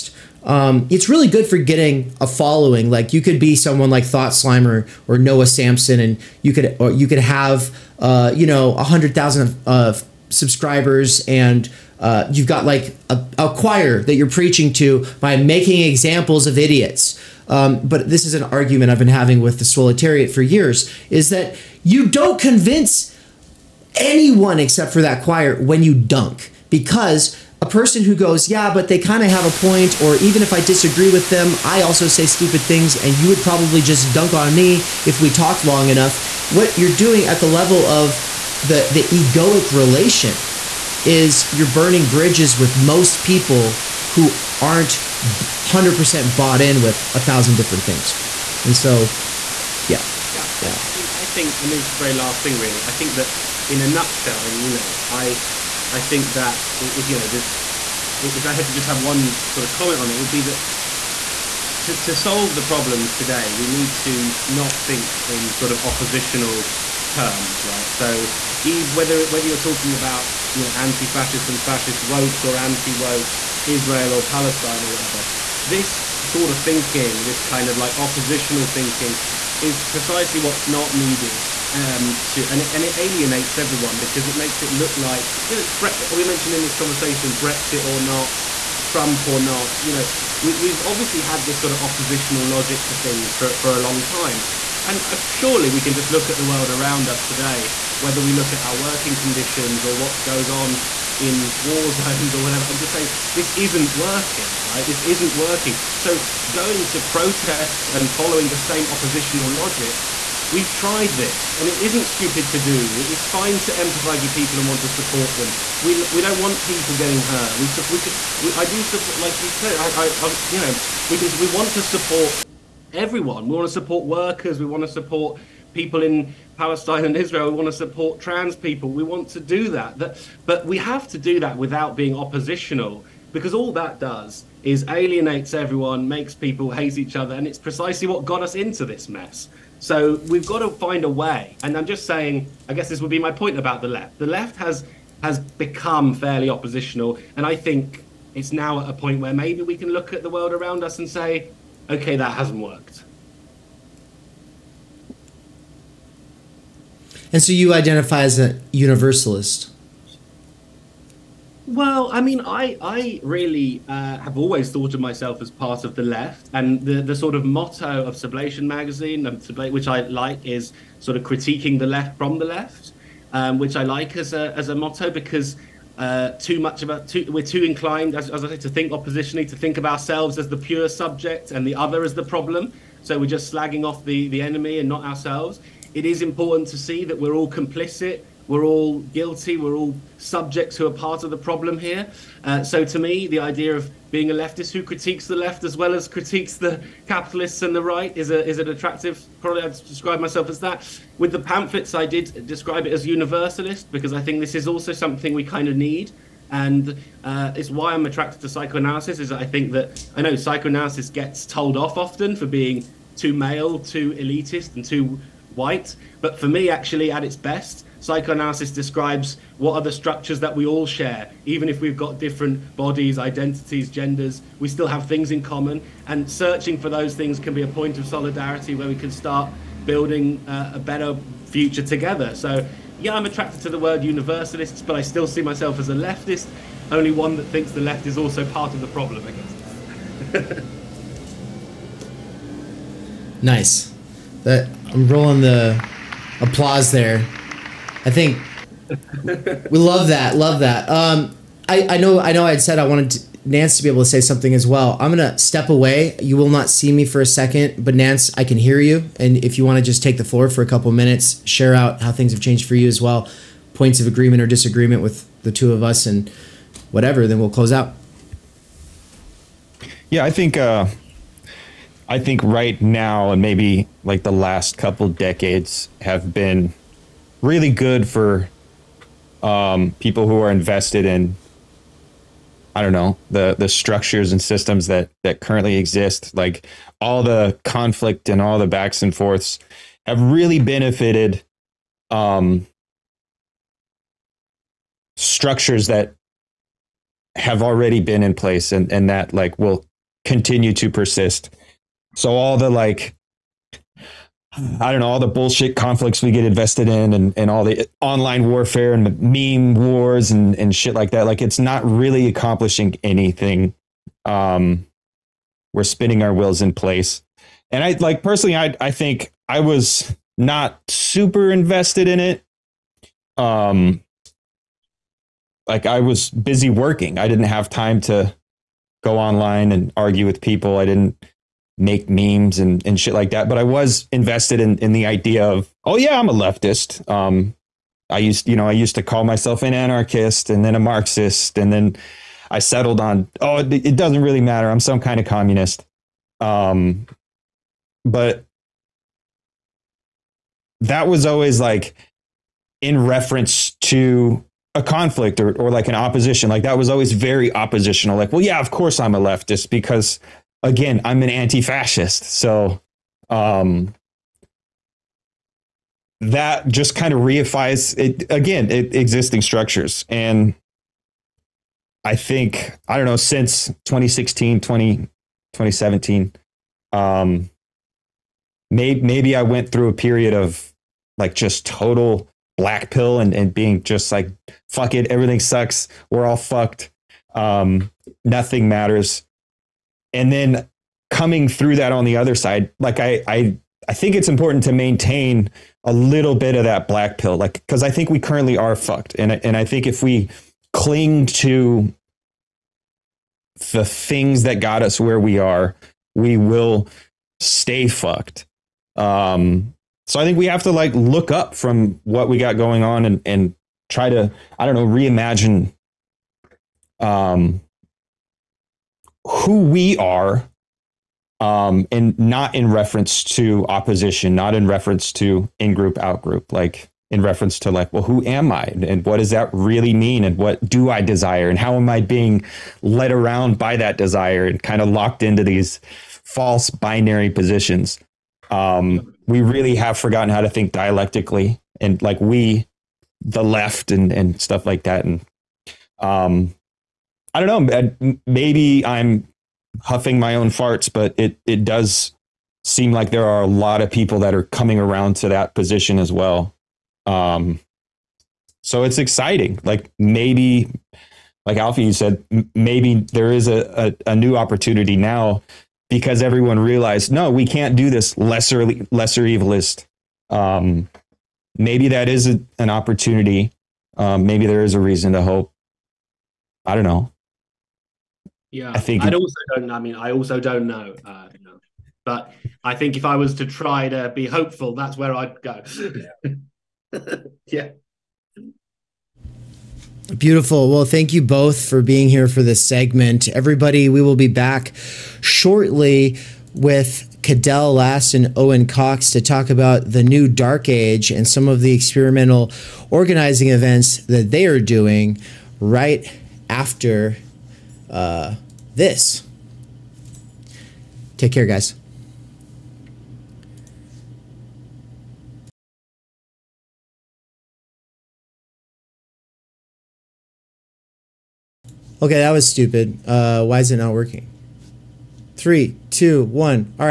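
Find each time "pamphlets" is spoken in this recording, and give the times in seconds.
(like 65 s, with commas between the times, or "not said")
201 s.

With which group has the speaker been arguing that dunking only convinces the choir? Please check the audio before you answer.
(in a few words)
the Solitariat.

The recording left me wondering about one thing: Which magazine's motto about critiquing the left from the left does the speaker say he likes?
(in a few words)
Sublation.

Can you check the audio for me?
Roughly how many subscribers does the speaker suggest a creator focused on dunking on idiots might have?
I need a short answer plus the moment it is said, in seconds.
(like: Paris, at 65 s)
100,000, at 8 s.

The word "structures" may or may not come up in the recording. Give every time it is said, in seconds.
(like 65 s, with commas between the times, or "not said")
219 s, 283 s, 295 s, 369 s.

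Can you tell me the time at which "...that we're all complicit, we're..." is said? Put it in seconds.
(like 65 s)
187 s.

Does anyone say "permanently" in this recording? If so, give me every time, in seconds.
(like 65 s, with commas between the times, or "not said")
not said.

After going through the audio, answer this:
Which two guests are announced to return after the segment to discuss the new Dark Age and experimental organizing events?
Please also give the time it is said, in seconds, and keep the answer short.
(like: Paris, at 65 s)
Cadell Last and Owen Cox, at 497 s.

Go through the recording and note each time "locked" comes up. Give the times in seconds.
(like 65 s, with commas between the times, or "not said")
434 s.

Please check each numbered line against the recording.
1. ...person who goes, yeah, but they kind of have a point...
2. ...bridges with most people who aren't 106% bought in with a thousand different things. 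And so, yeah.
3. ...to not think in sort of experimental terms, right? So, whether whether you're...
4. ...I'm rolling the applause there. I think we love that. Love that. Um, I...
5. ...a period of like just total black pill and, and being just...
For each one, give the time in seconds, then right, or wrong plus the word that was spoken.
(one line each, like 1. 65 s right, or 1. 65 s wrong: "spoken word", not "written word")
1. 27 s right
2. 42 s wrong: "100", not "106"
3. 63 s wrong: "oppositional", not "experimental"
4. 244 s right
5. 379 s right.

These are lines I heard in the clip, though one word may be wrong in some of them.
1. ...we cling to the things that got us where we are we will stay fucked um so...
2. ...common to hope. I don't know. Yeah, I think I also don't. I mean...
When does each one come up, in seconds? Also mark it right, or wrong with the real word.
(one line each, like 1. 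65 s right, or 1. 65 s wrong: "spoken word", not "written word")
1. 400 s right
2. 474 s wrong: "reason", not "common".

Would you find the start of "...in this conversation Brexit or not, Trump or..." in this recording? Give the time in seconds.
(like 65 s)
86 s.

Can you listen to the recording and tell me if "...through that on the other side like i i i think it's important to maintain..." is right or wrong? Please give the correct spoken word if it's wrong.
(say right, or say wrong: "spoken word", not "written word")
right.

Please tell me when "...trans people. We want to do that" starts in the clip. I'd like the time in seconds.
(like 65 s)
128 s.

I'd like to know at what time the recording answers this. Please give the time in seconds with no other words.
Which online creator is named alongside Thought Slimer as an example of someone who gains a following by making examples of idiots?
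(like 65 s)
5 s.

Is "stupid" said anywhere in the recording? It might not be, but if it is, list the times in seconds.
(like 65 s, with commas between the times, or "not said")
32 s, 112 s, 522 s.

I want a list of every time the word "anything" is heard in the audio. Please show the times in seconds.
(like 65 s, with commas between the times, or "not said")
313 s.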